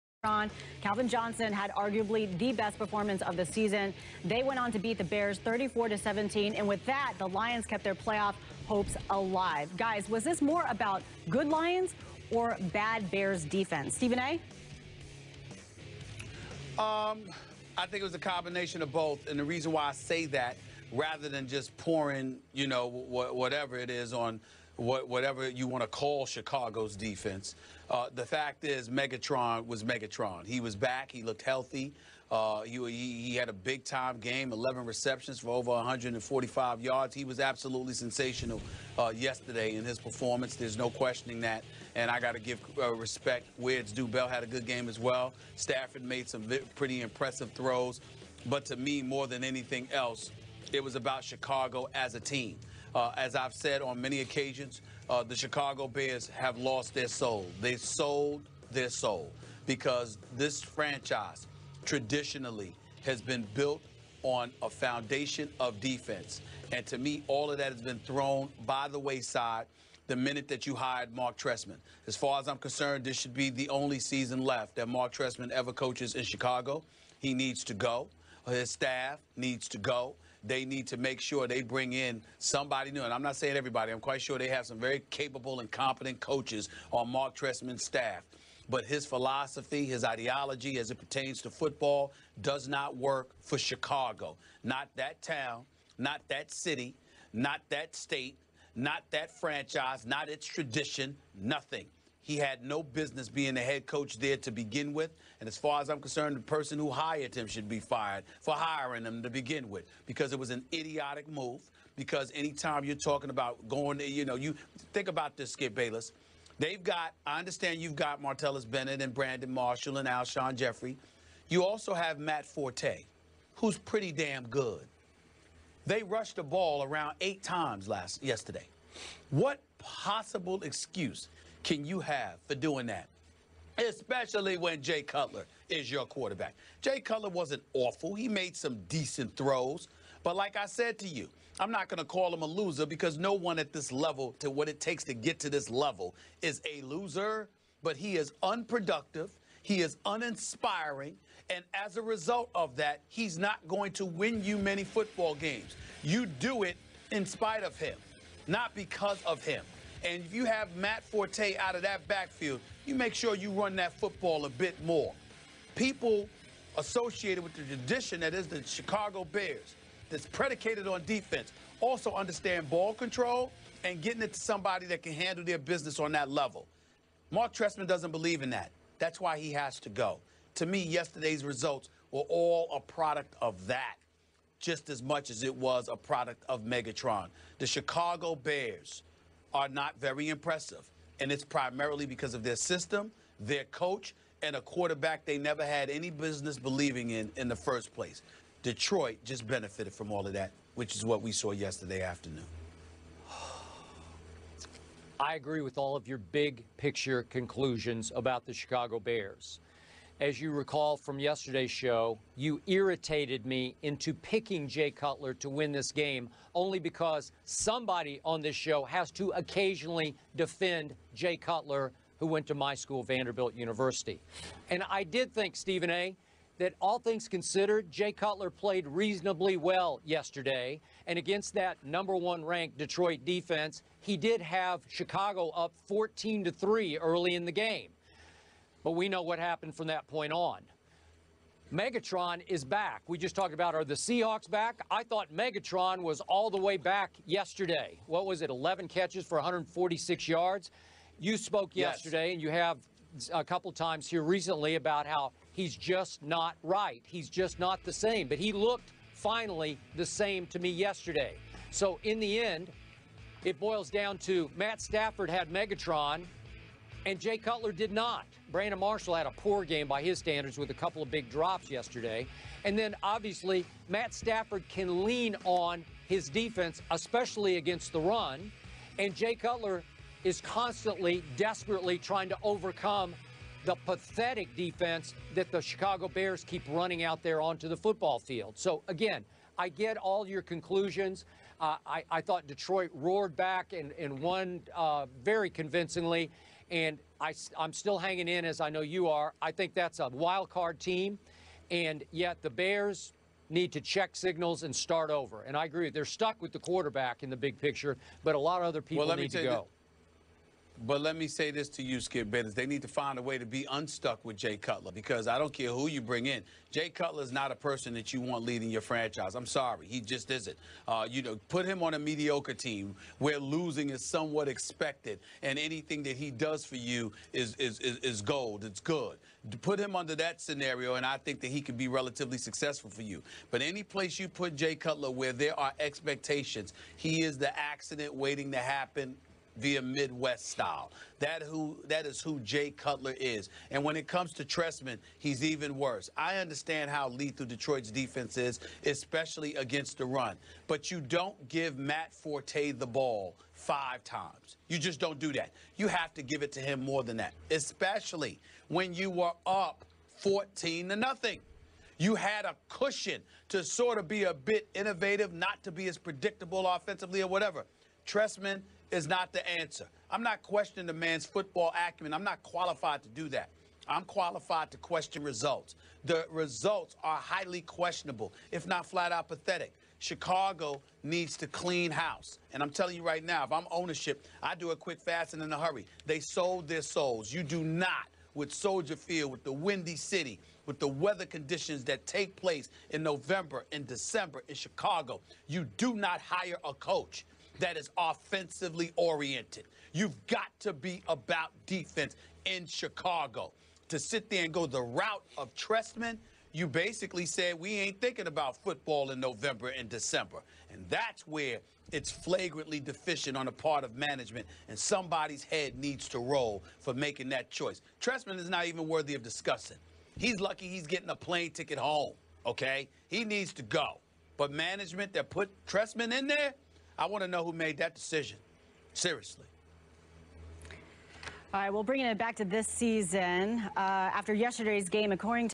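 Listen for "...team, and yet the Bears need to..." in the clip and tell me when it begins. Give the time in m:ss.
5:00.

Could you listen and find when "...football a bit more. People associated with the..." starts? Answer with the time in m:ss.
2:43.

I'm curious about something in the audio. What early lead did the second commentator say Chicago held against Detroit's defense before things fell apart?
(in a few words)
14 to 3.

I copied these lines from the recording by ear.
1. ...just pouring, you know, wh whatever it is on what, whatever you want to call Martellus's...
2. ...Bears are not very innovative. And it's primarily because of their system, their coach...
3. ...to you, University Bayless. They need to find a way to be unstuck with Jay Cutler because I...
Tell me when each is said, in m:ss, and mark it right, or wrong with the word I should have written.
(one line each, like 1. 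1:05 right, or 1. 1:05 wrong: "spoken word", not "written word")
1. 0:21 wrong: "Chicago", not "Martellus"
2. 3:08 wrong: "impressive", not "innovative"
3. 5:11 wrong: "Skip", not "University".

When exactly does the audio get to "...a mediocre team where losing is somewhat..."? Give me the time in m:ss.
5:21.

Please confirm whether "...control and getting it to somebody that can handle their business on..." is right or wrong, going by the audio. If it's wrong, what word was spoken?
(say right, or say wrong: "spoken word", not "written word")
right.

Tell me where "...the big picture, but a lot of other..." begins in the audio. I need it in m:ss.
5:07.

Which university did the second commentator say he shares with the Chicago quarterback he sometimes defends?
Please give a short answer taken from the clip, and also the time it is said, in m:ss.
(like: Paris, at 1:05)
Vanderbilt University, at 3:43.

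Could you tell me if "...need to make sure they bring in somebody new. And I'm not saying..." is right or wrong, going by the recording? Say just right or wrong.
right.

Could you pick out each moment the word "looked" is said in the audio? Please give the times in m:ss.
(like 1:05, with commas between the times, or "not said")
0:31, 4:18.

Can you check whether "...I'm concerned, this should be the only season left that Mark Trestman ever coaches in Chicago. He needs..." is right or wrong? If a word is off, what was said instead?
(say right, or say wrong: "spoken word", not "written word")
right.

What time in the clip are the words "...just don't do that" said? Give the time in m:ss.
5:54.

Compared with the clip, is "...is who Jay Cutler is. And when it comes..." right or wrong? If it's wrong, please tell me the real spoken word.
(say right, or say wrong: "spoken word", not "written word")
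right.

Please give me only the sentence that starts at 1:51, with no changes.
Because anytime you're talking about going, to, you know, you think about this, Skip Bayless.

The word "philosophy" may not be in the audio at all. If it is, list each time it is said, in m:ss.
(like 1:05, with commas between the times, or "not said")
1:29.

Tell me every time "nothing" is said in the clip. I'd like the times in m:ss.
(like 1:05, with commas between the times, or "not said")
1:41, 6:00.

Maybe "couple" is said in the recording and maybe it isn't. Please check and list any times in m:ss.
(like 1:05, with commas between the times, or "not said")
4:13, 4:30.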